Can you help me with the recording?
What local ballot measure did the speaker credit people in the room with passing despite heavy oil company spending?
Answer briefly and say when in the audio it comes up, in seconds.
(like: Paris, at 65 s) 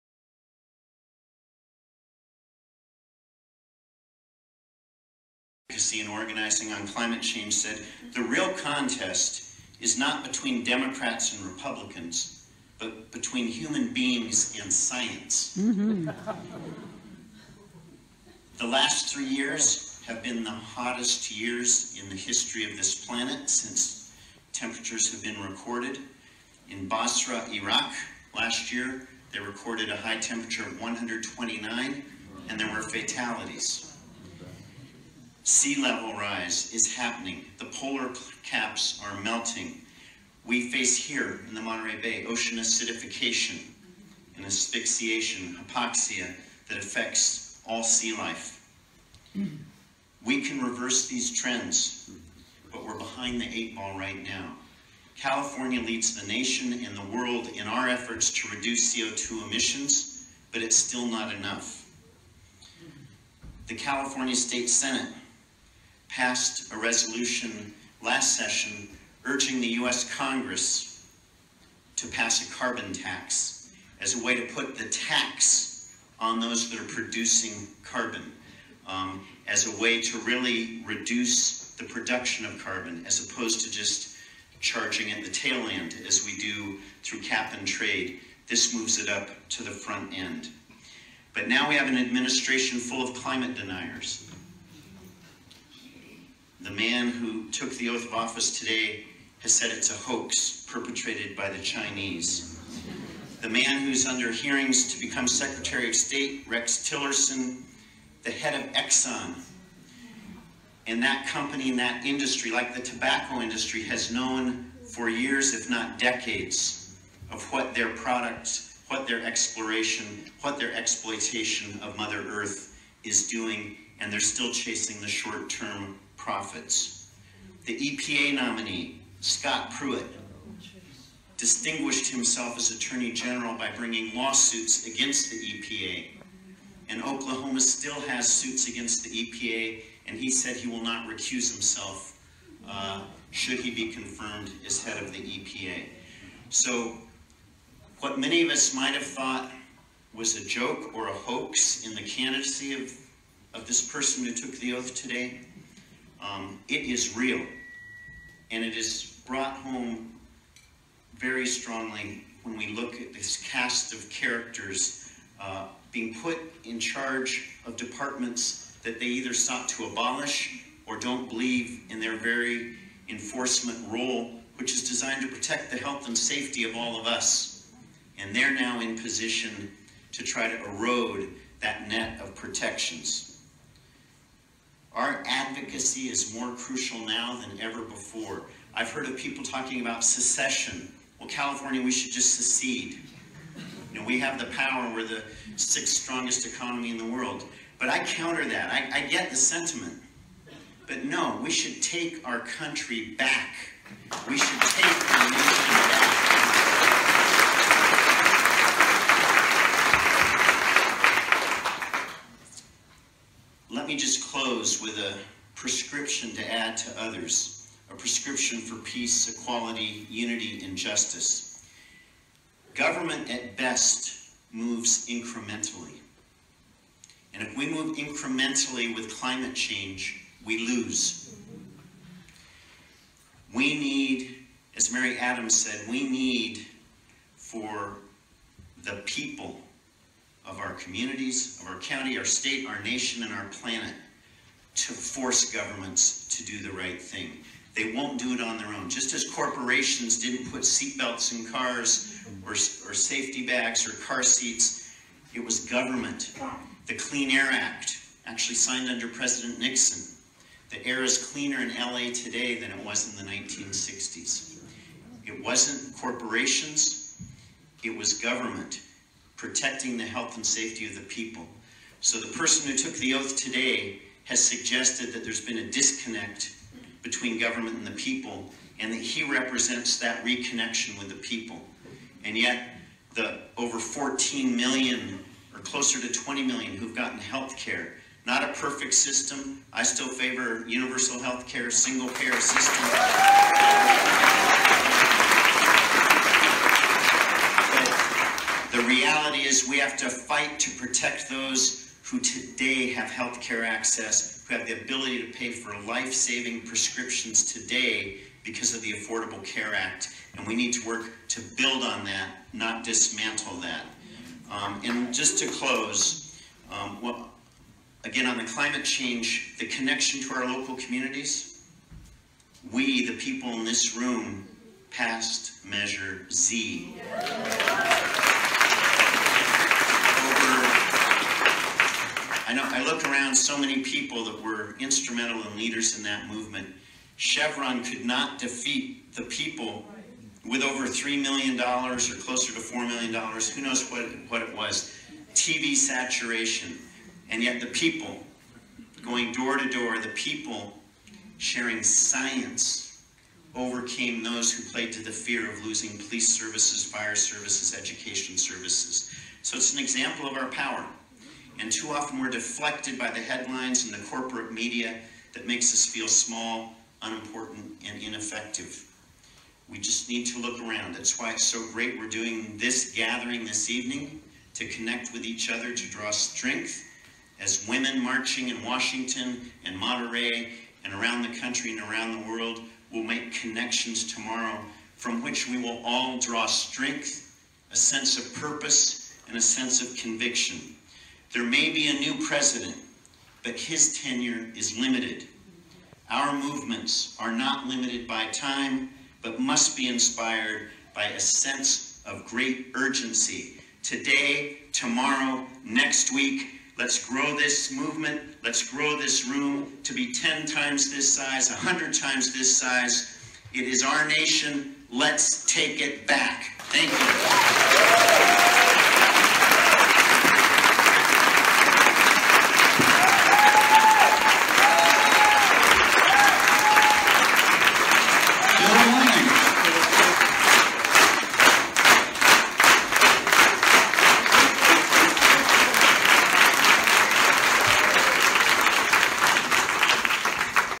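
Measure Z, at 325 s.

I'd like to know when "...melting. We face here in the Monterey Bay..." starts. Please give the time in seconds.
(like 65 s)
39 s.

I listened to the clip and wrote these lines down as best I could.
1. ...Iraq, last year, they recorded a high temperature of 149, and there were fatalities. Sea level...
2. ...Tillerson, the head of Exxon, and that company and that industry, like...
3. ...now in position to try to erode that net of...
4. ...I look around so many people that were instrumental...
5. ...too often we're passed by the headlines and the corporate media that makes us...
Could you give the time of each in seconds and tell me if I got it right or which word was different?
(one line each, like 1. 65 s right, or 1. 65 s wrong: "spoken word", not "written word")
1. 27 s wrong: "129", not "149"
2. 106 s right
3. 178 s right
4. 332 s right
5. 361 s wrong: "deflected", not "passed".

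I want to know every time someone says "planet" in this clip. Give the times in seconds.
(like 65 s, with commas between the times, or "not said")
23 s, 243 s.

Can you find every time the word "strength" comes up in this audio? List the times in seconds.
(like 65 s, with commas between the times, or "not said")
376 s, 386 s.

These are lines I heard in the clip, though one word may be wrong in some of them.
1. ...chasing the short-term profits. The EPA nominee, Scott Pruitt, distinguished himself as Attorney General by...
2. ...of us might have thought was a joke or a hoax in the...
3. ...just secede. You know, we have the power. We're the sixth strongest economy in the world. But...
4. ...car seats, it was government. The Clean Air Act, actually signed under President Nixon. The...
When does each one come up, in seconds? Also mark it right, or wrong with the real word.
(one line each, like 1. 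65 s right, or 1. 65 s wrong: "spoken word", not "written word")
1. 124 s right
2. 148 s right
3. 192 s right
4. 254 s right.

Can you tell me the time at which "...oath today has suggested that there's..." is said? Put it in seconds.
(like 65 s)
273 s.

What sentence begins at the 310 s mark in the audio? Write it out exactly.
And we need to work to build on that, not dismantle that.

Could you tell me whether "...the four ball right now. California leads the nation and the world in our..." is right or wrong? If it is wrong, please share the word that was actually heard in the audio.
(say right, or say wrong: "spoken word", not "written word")
wrong: "eight", not "four".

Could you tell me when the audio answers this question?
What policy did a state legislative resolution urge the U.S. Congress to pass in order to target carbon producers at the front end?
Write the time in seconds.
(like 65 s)
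72 s.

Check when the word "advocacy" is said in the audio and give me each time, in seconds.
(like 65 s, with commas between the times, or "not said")
5 s, 185 s.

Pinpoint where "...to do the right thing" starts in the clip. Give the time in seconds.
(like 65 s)
246 s.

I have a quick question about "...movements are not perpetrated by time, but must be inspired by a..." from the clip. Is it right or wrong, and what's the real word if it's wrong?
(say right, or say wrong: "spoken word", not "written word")
wrong: "limited", not "perpetrated".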